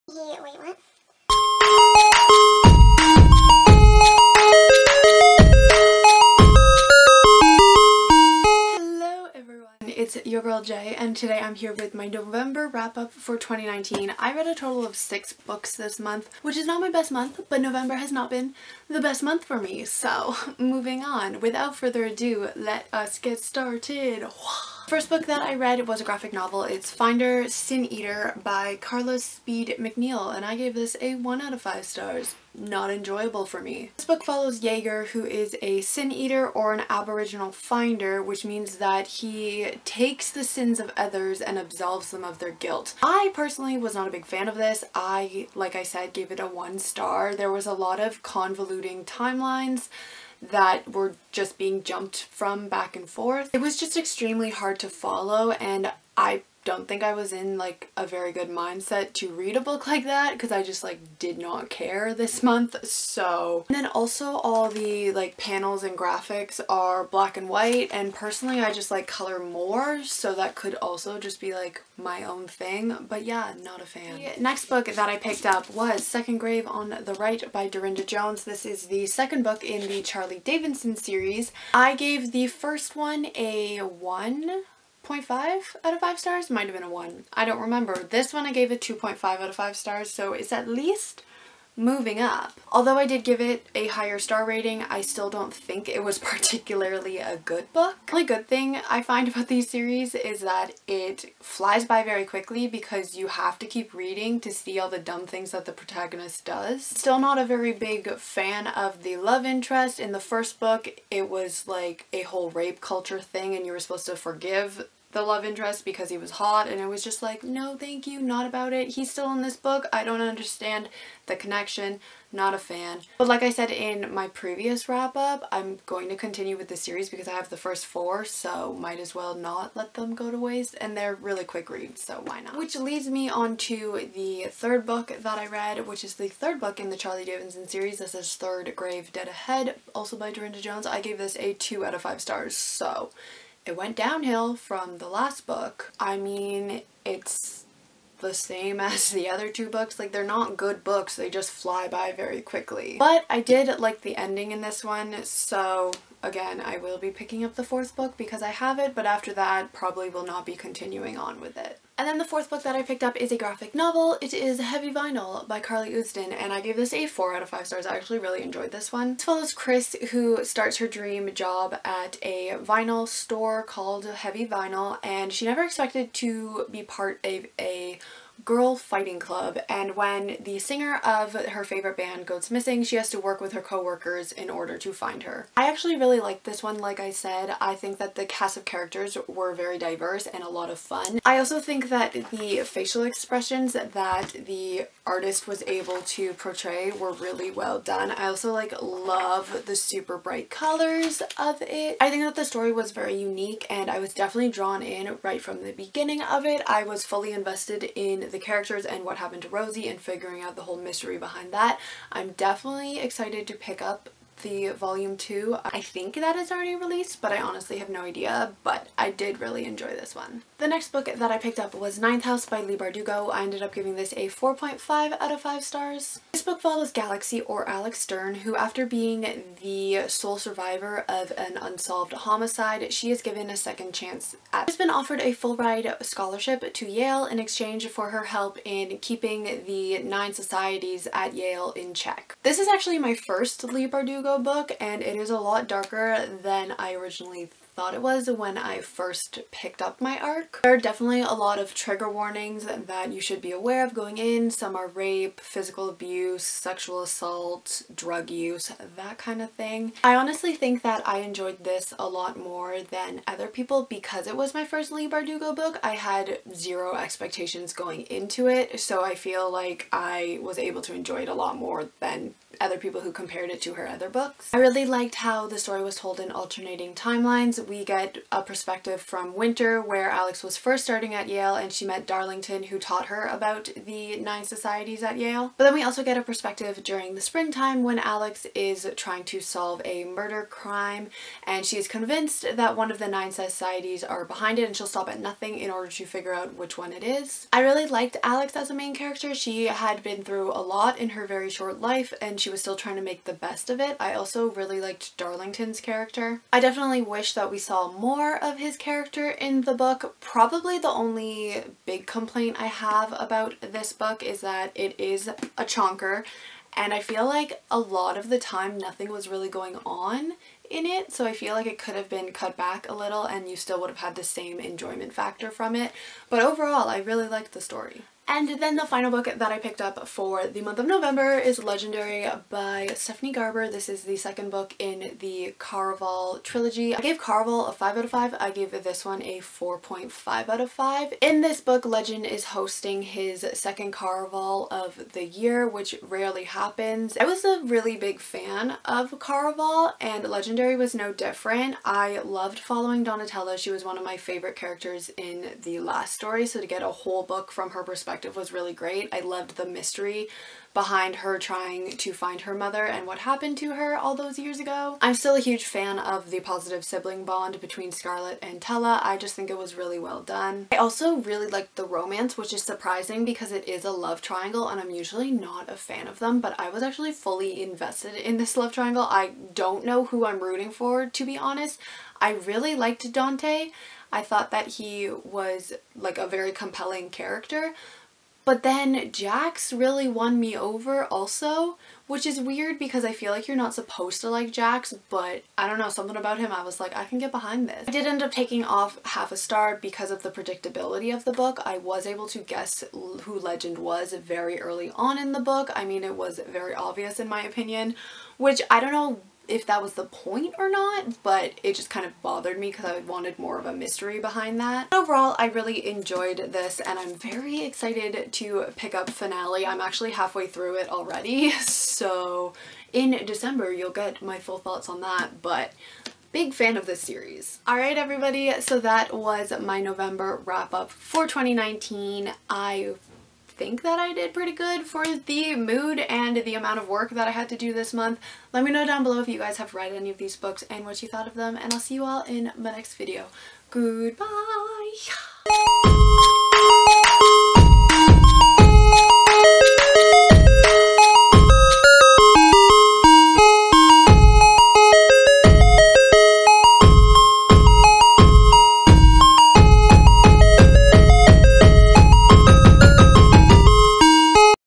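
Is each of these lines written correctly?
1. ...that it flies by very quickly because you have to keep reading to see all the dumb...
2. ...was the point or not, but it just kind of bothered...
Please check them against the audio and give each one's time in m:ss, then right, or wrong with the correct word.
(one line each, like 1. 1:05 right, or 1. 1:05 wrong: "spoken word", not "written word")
1. 1:40 right
2. 6:49 right.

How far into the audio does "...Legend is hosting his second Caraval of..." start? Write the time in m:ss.
5:41.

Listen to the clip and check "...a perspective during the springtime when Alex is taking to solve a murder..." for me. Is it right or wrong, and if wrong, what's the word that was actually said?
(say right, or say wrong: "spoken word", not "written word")
wrong: "trying", not "taking".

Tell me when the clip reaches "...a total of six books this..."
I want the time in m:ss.
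0:14.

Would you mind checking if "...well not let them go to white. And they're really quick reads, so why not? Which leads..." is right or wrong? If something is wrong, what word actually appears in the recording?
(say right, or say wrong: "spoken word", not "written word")
wrong: "waste", not "white".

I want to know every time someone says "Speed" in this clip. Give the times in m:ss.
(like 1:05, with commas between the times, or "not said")
0:29.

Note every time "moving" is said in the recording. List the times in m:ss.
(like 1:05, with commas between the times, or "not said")
0:20, 1:31.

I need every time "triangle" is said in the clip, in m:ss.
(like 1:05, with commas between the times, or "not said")
6:14, 6:18.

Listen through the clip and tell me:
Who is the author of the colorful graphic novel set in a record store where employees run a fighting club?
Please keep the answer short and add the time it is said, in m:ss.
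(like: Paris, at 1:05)
Carly Usdin, at 2:45.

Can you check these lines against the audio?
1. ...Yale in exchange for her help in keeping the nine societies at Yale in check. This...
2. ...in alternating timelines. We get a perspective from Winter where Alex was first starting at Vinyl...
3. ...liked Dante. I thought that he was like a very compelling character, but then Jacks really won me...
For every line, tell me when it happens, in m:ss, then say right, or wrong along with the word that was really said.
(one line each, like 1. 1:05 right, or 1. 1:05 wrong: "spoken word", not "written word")
1. 3:56 right
2. 4:36 wrong: "Yale", not "Vinyl"
3. 6:22 right.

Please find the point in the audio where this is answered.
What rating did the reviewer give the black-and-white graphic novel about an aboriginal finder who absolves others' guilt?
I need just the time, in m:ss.
0:31.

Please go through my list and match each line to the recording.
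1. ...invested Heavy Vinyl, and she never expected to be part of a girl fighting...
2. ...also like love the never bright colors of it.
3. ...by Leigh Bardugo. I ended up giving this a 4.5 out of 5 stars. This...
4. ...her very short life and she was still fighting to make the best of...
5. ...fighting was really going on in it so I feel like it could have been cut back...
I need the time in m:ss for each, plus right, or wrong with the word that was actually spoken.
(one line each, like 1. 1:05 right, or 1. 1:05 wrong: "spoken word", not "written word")
1. 2:53 wrong: "called", not "invested"
2. 3:18 wrong: "super", not "never"
3. 3:42 right
4. 5:01 wrong: "trying", not "fighting"
5. 5:18 wrong: "nothing", not "fighting".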